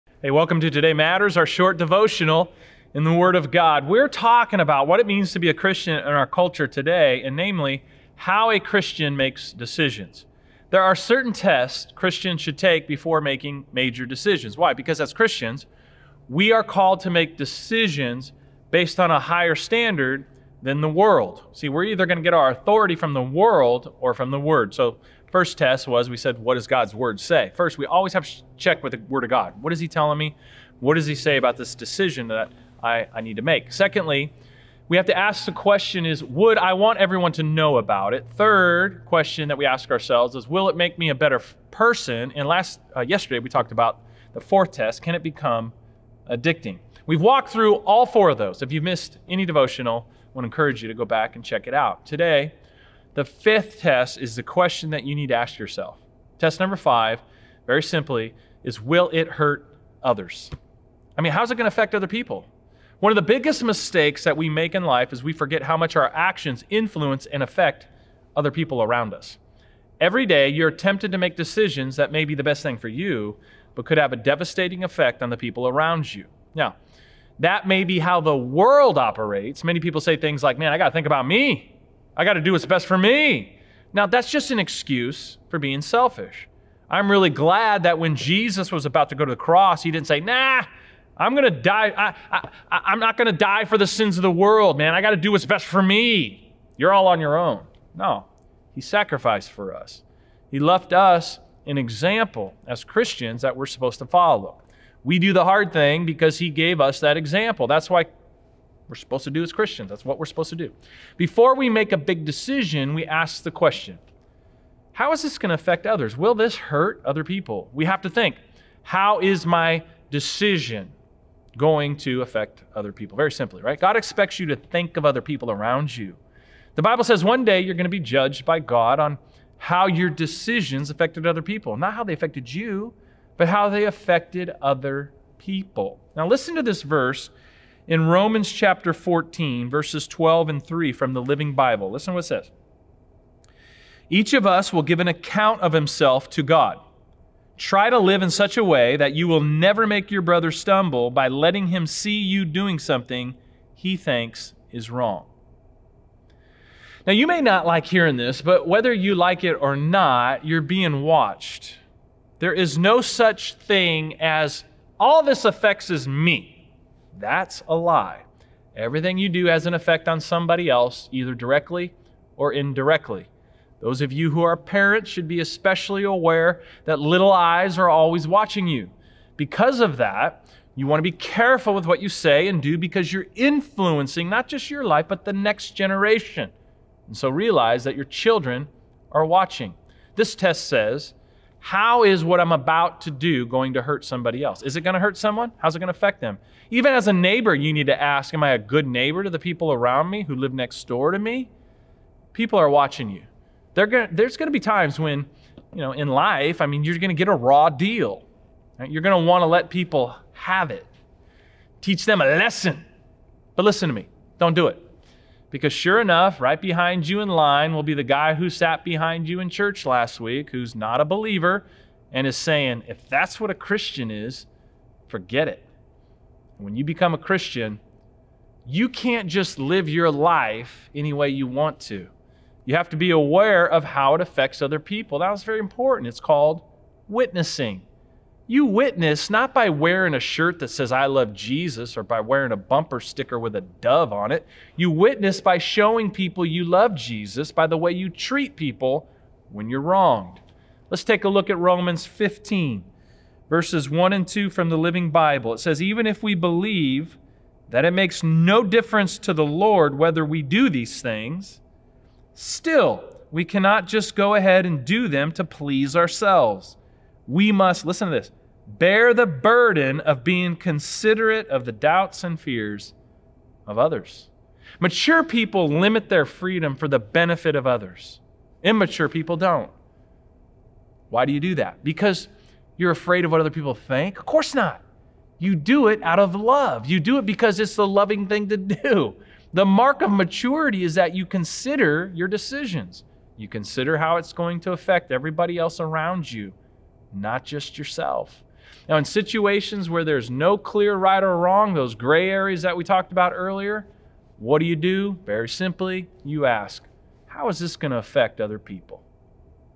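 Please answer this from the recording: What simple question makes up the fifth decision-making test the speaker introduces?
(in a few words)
Will it hurt others?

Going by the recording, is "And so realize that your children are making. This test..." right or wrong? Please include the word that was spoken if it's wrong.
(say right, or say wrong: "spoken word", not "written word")
wrong: "watching", not "making".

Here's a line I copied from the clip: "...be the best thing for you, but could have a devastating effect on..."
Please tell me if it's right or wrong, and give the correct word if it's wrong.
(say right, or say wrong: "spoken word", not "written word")
right.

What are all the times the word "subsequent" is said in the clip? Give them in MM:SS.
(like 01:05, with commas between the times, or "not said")
not said.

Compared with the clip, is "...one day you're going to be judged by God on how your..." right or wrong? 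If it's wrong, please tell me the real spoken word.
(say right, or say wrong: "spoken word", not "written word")
right.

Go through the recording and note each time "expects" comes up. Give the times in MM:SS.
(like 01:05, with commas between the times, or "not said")
02:03.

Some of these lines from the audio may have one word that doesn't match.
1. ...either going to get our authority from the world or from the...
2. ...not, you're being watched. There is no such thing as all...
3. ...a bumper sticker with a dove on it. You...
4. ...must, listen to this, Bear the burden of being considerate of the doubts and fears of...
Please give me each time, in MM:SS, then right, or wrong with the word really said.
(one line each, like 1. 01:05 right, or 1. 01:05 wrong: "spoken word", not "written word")
1. 00:21 right
2. 02:39 right
3. 04:02 right
4. 04:27 right.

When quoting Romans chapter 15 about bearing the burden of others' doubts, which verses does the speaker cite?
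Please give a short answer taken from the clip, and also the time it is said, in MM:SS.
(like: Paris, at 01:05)
1 and 2, at 04:13.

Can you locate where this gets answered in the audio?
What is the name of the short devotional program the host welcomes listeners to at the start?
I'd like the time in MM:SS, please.
00:00.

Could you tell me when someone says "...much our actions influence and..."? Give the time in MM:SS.
01:05.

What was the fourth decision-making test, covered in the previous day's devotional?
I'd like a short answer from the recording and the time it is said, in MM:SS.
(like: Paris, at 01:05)
Can it become addicting?, at 00:45.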